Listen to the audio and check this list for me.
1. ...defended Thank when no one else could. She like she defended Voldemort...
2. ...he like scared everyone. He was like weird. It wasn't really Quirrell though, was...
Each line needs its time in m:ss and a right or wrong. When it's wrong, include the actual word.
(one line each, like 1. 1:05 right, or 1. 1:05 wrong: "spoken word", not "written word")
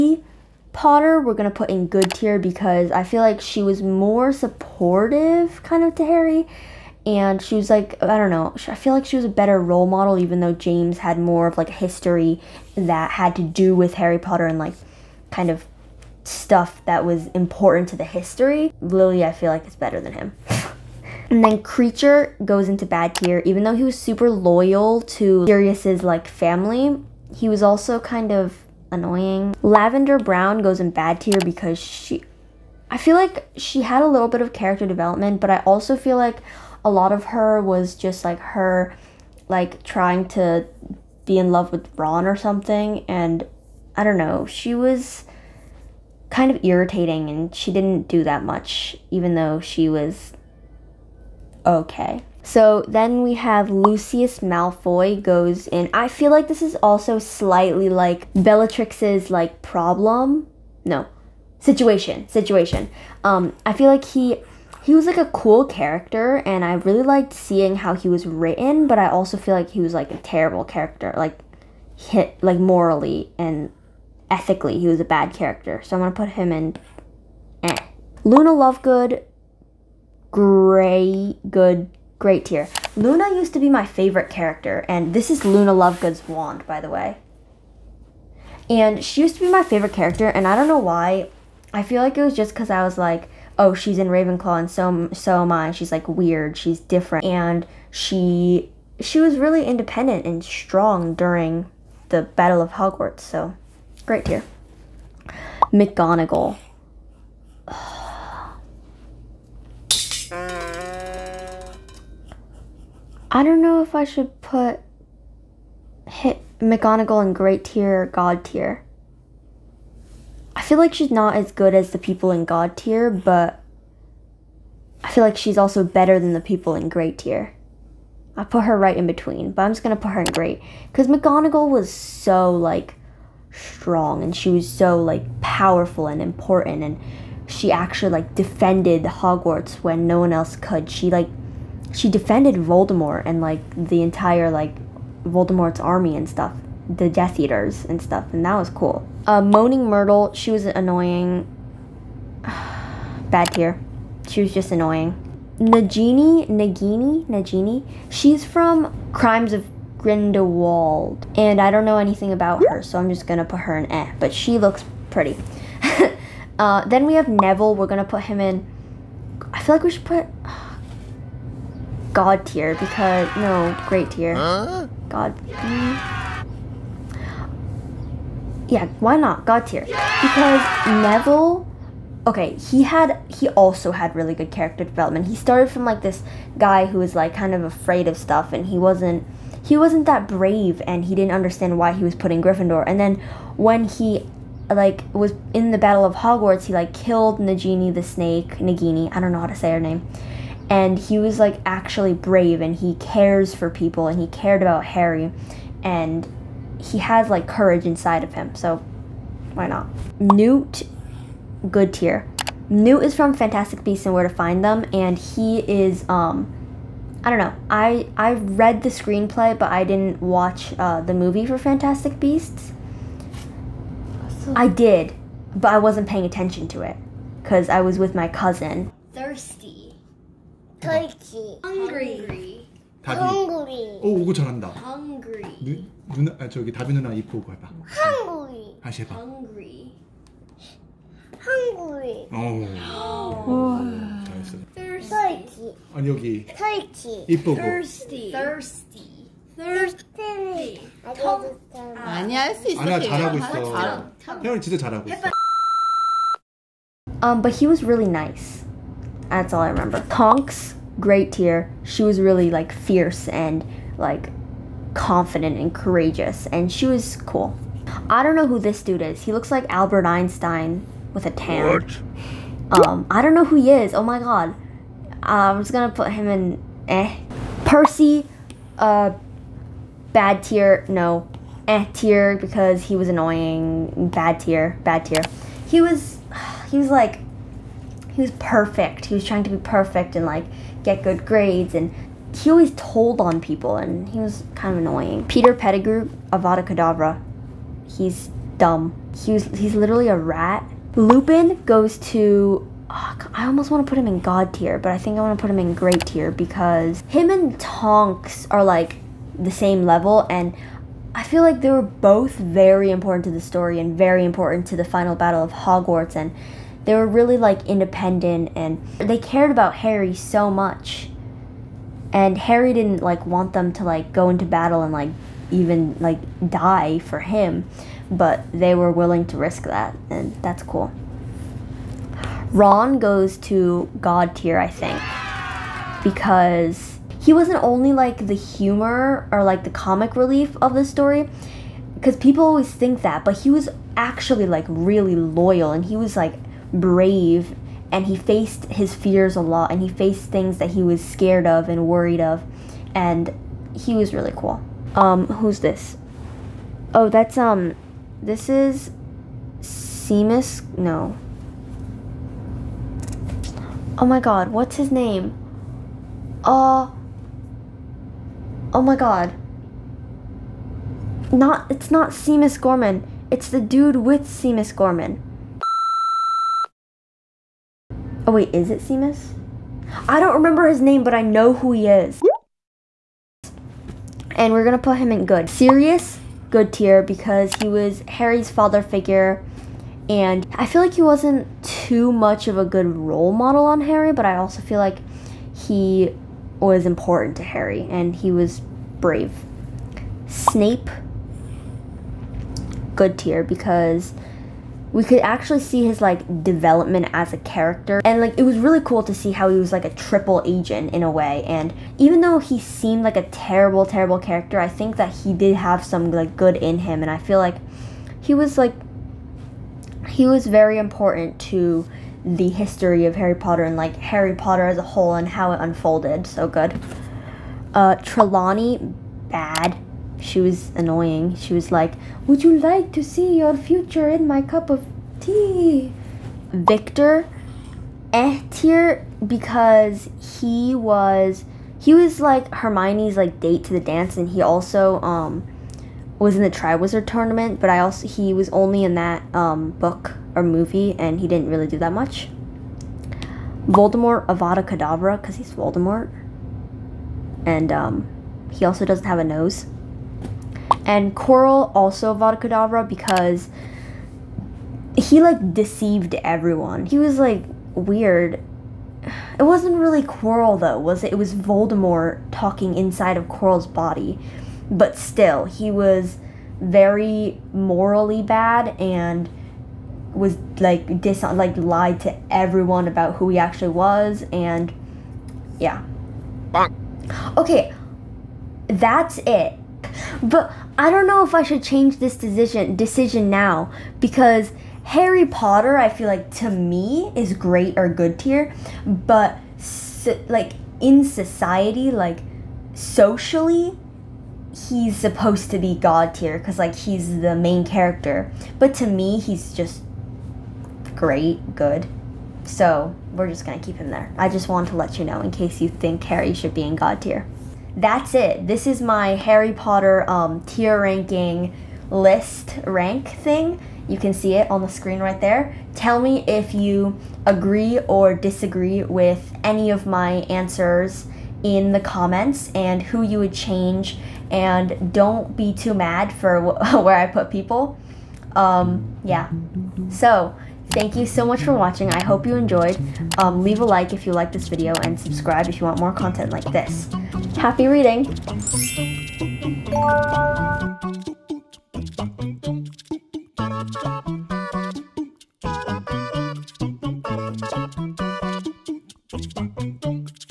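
1. 2:18 wrong: "Hogwarts", not "Thank"
2. 7:44 wrong: "deceived", not "scared".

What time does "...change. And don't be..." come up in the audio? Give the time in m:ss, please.
8:53.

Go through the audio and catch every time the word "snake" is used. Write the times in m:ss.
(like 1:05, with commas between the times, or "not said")
3:18.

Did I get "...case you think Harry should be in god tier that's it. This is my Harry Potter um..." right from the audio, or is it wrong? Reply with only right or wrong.
right.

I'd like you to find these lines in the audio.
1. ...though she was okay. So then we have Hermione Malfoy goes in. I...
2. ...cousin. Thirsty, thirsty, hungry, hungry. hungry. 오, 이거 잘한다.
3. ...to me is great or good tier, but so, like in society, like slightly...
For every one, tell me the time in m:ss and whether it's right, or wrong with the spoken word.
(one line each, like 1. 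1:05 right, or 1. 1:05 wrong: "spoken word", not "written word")
1. 0:49 wrong: "Lucius", not "Hermione"
2. 3:48 right
3. 8:16 wrong: "socially", not "slightly".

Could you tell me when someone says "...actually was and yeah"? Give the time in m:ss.
8:03.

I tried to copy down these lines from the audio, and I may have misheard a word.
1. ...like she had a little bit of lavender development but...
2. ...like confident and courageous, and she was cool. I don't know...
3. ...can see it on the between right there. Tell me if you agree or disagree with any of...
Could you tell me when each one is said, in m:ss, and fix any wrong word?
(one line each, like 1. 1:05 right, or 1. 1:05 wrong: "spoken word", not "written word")
1. 0:33 wrong: "character", not "lavender"
2. 4:23 right
3. 8:43 wrong: "screen", not "between".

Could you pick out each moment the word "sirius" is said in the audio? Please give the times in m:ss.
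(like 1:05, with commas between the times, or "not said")
0:25, 6:25.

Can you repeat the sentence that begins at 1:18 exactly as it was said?
Luna Lovegood great good great tier.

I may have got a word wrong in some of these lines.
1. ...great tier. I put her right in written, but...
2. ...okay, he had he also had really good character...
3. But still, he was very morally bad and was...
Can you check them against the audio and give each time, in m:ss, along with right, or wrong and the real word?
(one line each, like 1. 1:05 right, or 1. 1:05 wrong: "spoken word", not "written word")
1. 2:06 wrong: "between", not "written"
2. 3:02 right
3. 7:54 right.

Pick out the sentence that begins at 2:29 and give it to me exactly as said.
Uh, Moaning Myrtle, she was annoying.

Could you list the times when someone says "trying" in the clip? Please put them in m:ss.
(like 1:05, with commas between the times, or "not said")
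0:39, 4:49.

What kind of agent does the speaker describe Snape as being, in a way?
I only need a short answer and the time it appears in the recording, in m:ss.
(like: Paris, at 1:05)
Triple agent, at 6:49.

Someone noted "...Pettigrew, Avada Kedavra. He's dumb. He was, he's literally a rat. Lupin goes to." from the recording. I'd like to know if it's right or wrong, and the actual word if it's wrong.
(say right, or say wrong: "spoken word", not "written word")
right.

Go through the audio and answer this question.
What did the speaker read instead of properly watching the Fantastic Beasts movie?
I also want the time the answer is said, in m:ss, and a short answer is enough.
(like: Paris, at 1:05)
The screenplay, at 3:38.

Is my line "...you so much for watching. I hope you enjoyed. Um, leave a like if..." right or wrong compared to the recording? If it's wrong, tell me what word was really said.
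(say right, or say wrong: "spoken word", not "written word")
right.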